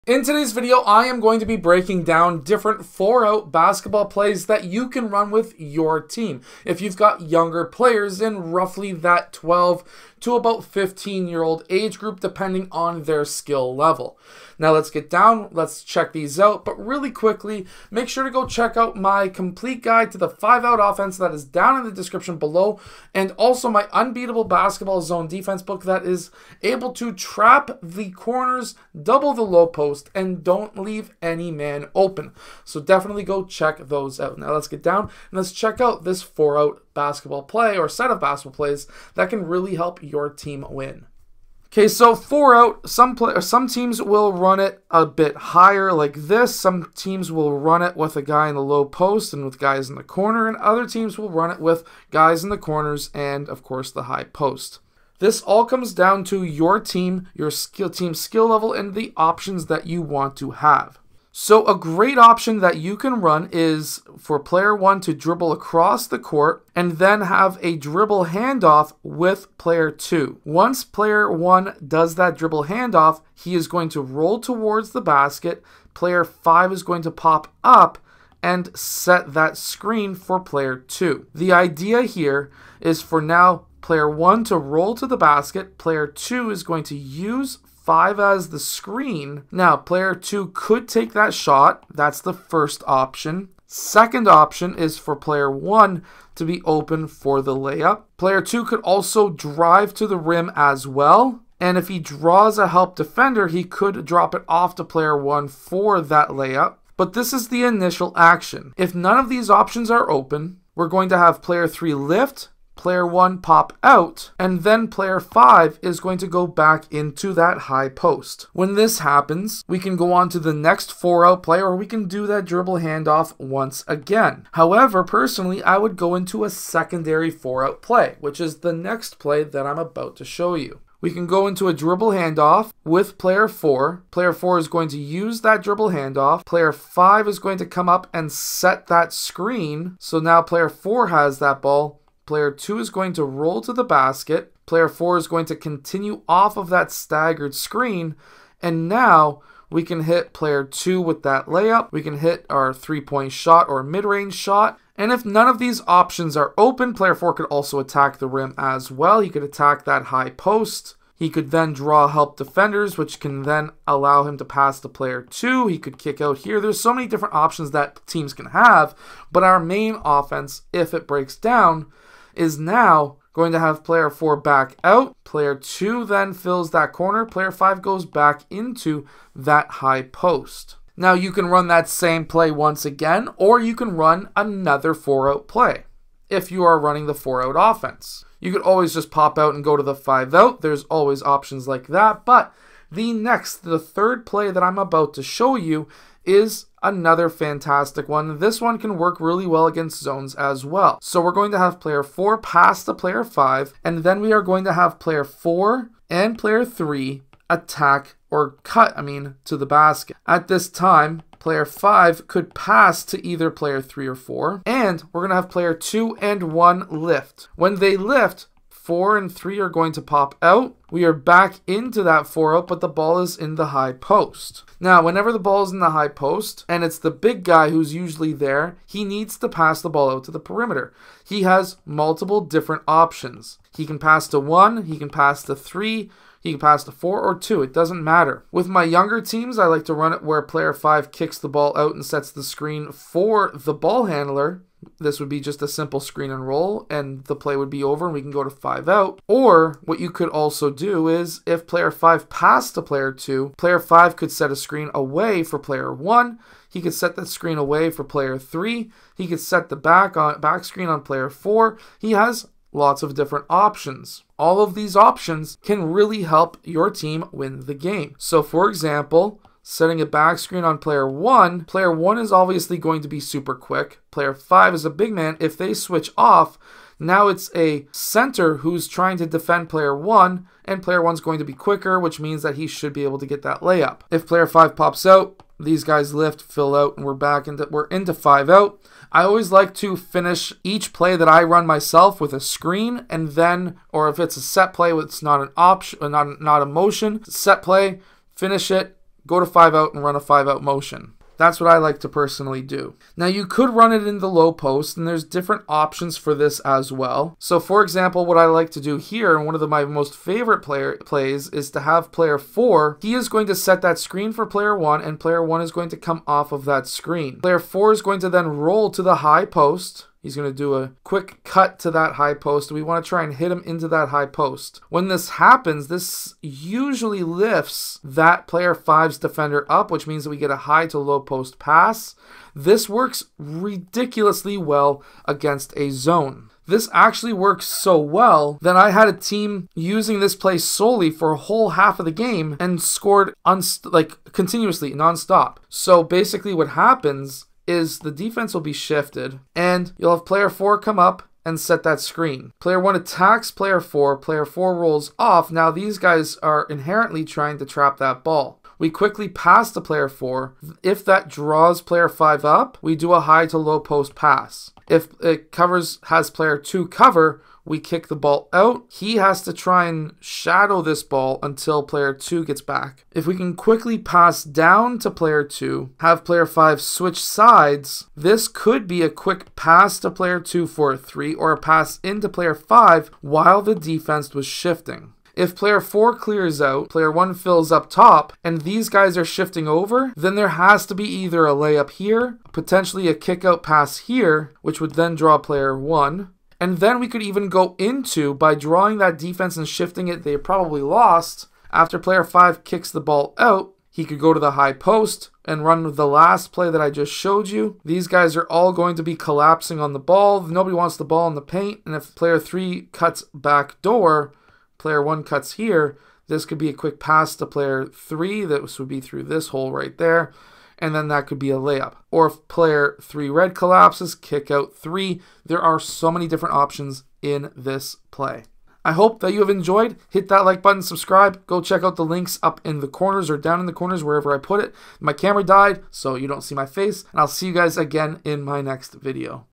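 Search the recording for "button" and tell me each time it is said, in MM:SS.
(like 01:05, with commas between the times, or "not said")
07:10.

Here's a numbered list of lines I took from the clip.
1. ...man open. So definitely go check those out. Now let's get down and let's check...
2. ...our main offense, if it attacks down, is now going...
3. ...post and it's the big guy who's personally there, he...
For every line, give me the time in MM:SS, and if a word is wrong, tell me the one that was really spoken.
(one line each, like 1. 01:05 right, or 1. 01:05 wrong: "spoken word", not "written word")
1. 00:31 right
2. 02:49 wrong: "breaks", not "attacks"
3. 03:46 wrong: "usually", not "personally".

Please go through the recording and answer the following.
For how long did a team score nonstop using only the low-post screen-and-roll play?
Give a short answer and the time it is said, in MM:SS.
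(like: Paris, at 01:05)
a whole half, at 05:41.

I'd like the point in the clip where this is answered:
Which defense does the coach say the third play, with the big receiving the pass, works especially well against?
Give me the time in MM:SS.
03:20.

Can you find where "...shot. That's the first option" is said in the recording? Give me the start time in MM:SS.
01:31.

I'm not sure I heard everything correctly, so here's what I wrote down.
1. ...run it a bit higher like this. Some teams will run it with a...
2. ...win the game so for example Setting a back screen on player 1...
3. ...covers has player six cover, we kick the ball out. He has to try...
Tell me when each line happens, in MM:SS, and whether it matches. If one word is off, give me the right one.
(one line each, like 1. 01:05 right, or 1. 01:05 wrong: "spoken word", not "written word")
1. 00:44 right
2. 04:27 right
3. 06:05 wrong: "two", not "six".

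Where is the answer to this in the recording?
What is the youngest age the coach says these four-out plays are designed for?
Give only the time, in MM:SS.
00:09.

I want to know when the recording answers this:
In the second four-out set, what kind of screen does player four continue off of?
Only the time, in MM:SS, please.
02:26.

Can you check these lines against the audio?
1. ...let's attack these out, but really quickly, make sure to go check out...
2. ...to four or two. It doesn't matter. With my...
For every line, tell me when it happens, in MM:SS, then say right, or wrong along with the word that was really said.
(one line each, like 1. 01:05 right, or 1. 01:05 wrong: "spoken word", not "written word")
1. 00:15 wrong: "check", not "attack"
2. 03:56 right.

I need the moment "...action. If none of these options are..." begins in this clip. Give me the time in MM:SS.
01:48.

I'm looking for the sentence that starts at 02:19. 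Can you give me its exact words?
So now player four has that ball Player two is going to roll to the basket.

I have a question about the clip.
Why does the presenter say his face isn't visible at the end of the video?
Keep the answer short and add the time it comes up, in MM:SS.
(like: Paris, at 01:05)
camera died, at 07:14.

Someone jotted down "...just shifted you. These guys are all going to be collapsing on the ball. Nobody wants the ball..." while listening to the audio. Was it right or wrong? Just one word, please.
wrong.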